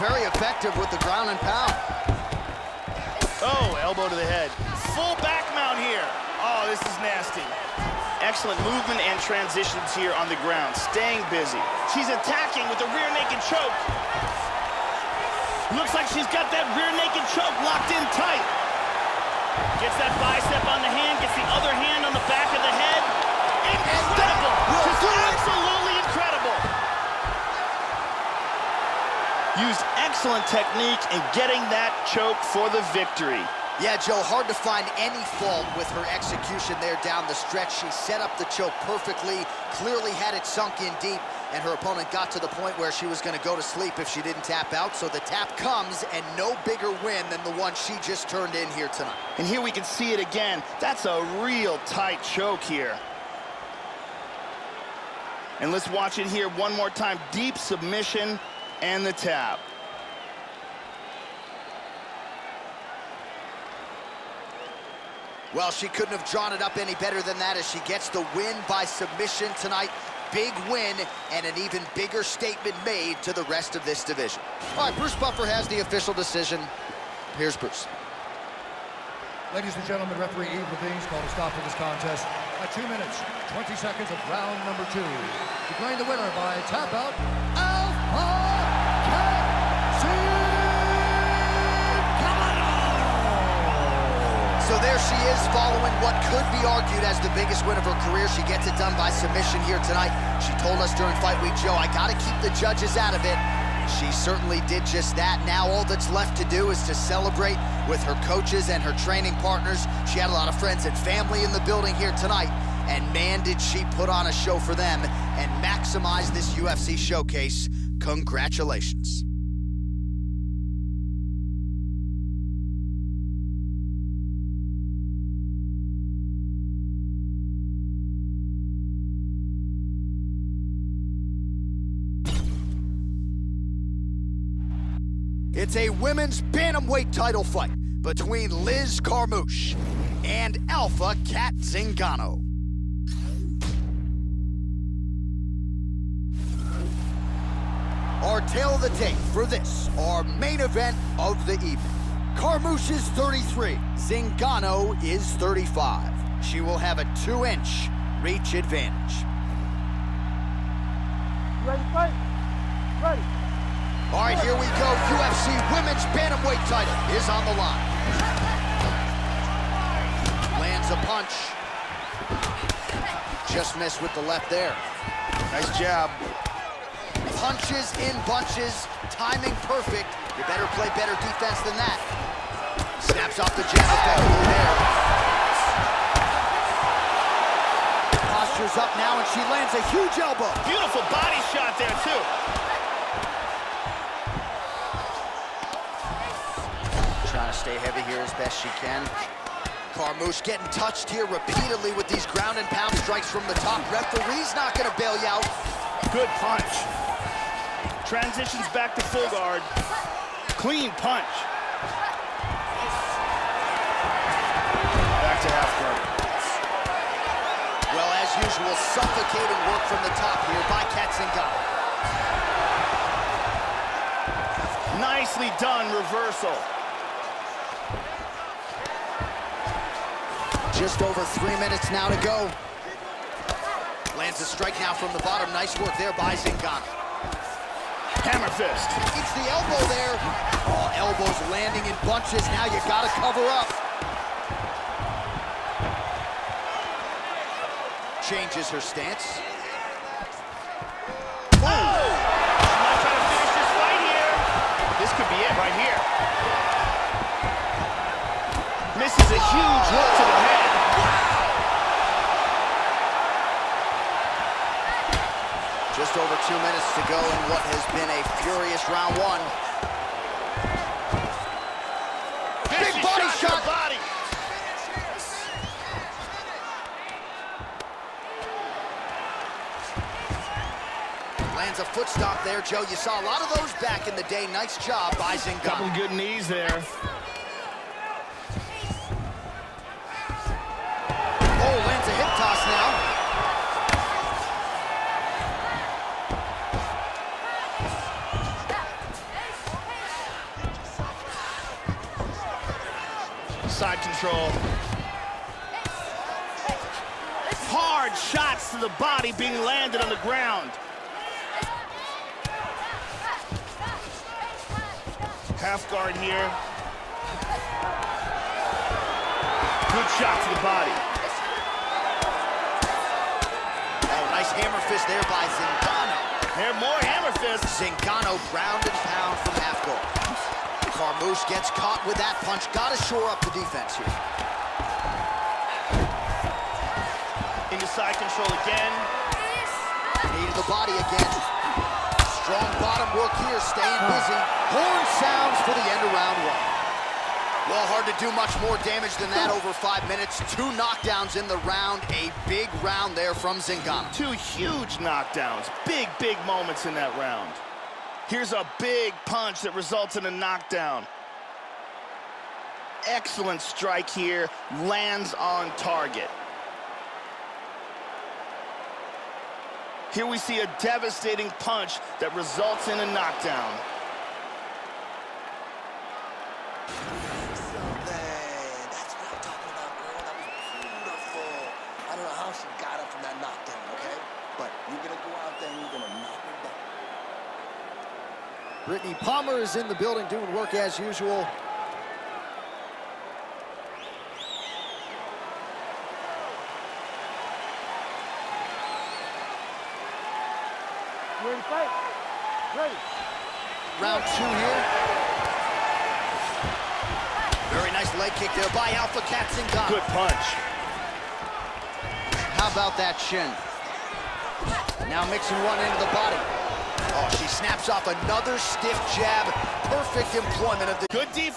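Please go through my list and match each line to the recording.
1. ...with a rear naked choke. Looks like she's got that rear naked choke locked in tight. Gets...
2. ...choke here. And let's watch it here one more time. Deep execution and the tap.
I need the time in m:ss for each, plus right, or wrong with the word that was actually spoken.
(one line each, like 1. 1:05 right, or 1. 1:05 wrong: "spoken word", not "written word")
1. 0:12 right
2. 0:52 wrong: "submission", not "execution".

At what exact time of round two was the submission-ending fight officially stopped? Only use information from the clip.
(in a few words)
2 minutes, 20 seconds.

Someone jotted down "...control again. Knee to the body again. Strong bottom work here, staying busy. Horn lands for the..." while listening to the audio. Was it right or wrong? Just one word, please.
wrong.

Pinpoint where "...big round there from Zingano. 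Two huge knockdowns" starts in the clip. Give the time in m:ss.
5:52.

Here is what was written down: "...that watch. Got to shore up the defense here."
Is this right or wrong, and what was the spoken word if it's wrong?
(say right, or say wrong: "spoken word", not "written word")
wrong: "punch", not "watch".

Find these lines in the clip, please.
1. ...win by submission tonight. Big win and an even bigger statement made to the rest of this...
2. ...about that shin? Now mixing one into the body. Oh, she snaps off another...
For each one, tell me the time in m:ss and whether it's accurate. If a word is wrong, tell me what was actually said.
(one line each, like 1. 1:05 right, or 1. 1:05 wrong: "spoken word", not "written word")
1. 1:08 right
2. 6:52 right.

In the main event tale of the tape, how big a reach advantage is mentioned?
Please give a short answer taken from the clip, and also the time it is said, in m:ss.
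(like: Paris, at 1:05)
2 inches, at 2:37.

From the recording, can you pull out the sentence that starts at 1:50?
She had a lot of friends and family in the building here tonight.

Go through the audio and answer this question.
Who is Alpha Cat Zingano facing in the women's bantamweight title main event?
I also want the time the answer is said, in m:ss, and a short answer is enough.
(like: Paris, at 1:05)
Liz Carmouche, at 2:18.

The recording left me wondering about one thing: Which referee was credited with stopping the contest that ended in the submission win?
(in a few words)
Yves Lavigne.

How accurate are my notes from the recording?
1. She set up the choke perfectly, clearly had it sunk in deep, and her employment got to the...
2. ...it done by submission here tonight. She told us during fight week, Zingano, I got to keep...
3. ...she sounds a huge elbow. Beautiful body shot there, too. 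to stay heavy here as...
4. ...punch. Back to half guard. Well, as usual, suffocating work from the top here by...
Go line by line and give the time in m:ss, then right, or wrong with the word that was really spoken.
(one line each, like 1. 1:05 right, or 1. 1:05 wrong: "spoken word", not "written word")
1. 0:37 wrong: "opponent", not "employment"
2. 1:38 wrong: "Joe", not "Zingano"
3. 3:09 wrong: "lands", not "sounds"
4. 3:30 right.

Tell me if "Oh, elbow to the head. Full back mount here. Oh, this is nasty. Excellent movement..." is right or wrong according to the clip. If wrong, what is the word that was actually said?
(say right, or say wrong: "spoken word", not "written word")
right.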